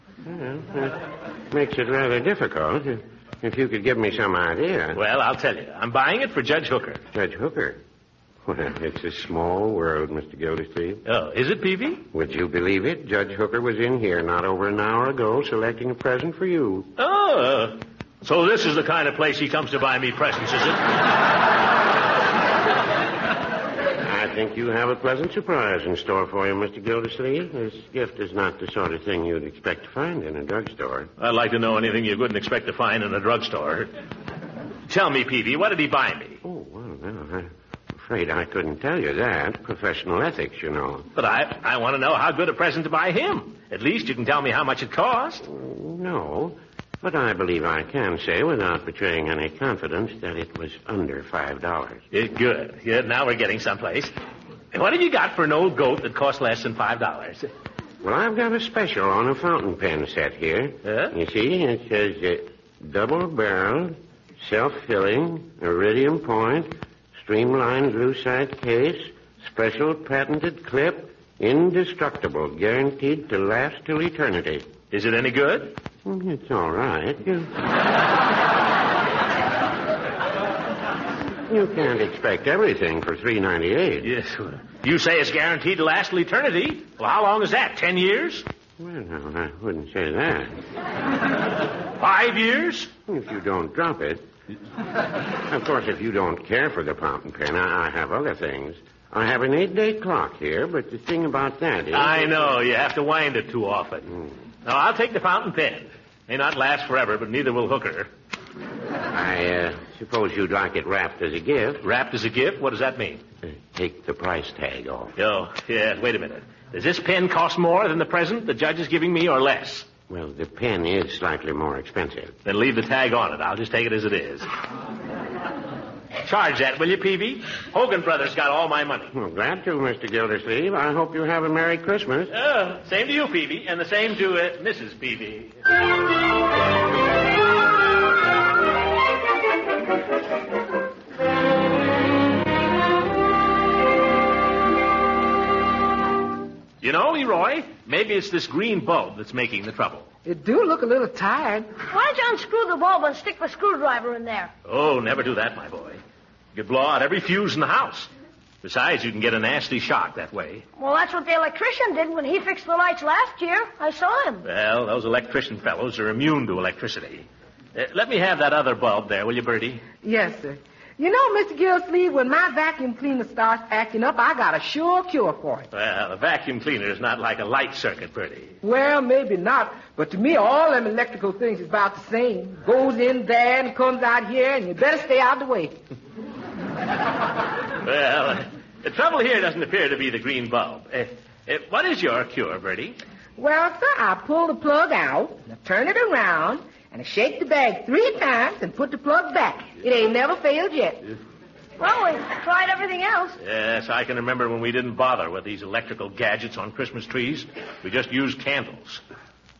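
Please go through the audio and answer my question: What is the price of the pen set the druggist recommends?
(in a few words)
$3.98.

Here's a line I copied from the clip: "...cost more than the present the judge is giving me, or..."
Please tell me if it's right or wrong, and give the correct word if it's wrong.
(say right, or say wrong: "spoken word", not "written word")
right.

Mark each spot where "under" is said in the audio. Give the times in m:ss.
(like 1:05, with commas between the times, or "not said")
0:50.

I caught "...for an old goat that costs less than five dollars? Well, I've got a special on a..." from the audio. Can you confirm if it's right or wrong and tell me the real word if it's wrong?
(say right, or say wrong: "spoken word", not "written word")
right.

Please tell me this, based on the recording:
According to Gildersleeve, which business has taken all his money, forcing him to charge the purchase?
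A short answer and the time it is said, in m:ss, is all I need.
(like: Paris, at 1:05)
Hogan Brothers, at 2:07.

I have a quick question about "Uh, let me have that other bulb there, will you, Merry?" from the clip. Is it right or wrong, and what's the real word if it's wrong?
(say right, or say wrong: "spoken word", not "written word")
wrong: "Birdie", not "Merry".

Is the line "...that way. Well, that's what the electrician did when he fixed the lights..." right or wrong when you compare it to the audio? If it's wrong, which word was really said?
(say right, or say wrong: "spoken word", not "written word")
right.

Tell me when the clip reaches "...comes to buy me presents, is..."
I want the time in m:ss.
0:19.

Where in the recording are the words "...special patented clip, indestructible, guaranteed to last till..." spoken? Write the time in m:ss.
1:09.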